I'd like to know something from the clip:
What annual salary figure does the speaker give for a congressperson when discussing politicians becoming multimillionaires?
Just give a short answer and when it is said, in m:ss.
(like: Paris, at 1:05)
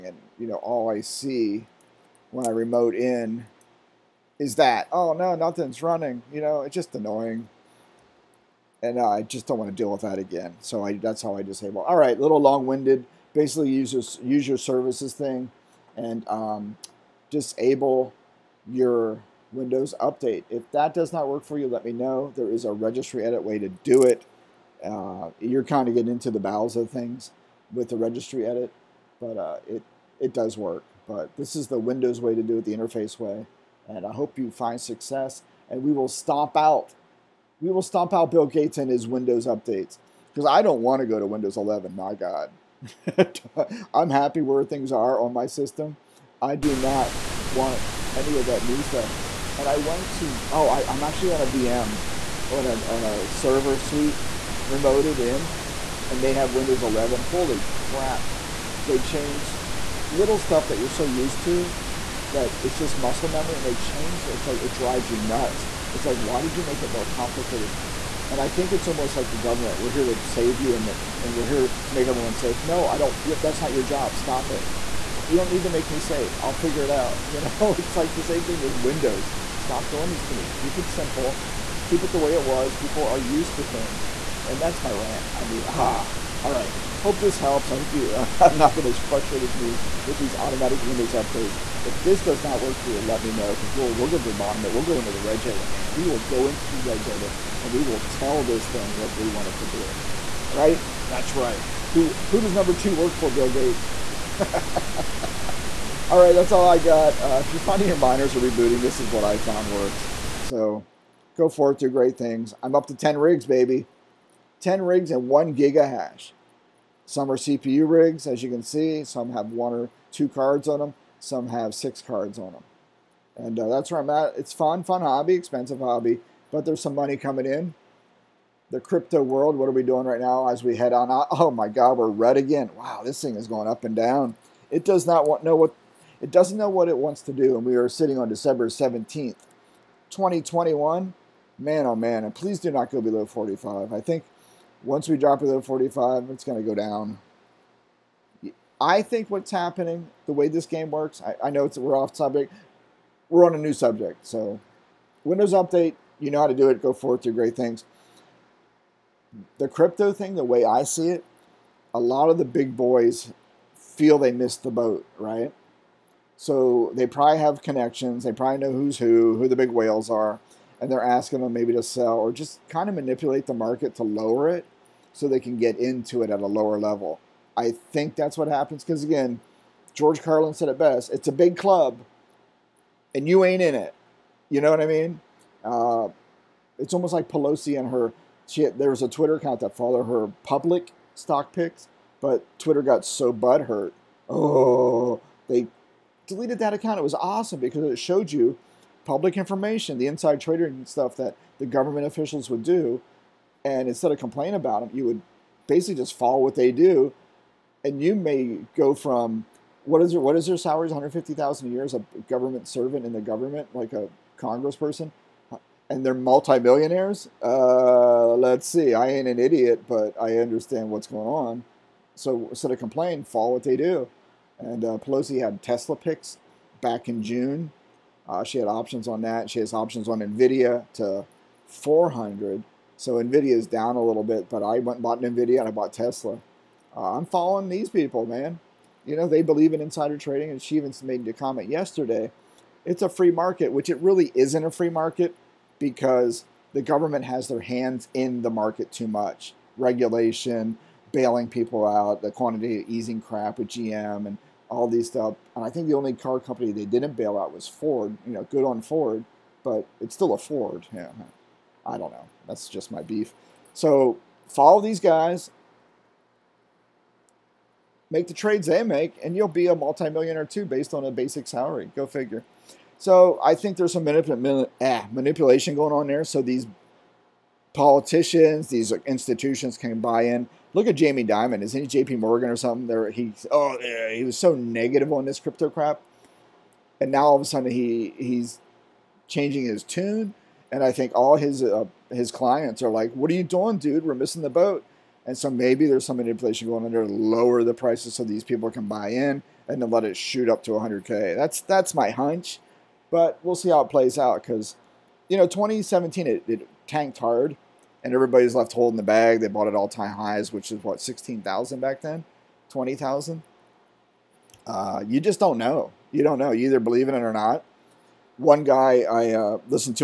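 $150,000, at 3:30.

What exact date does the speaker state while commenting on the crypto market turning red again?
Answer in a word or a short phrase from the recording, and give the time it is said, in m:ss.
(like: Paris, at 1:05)
December 17th, 2021, at 2:18.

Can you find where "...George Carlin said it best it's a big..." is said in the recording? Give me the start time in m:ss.
2:59.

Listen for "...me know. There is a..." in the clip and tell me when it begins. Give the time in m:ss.
0:21.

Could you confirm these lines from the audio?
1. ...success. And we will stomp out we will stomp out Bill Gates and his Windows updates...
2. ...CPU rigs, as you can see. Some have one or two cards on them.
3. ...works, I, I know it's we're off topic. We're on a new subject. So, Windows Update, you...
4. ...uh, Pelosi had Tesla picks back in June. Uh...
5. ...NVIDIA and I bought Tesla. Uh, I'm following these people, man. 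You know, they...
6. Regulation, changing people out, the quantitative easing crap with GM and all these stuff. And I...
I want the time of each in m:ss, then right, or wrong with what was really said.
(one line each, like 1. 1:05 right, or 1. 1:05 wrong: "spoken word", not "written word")
1. 0:34 right
2. 1:57 right
3. 2:30 right
4. 3:44 right
5. 3:55 right
6. 4:09 wrong: "bailing", not "changing".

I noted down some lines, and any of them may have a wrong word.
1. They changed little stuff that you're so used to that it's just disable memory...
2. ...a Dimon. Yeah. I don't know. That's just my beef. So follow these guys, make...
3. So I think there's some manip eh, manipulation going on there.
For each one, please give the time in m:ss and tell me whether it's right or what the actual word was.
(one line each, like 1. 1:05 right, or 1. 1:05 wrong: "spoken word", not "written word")
1. 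0:58 wrong: "muscle", not "disable"
2. 4:20 wrong: "Ford", not "Dimon"
3. 4:32 right.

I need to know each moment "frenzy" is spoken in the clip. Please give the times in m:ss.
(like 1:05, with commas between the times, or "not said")
not said.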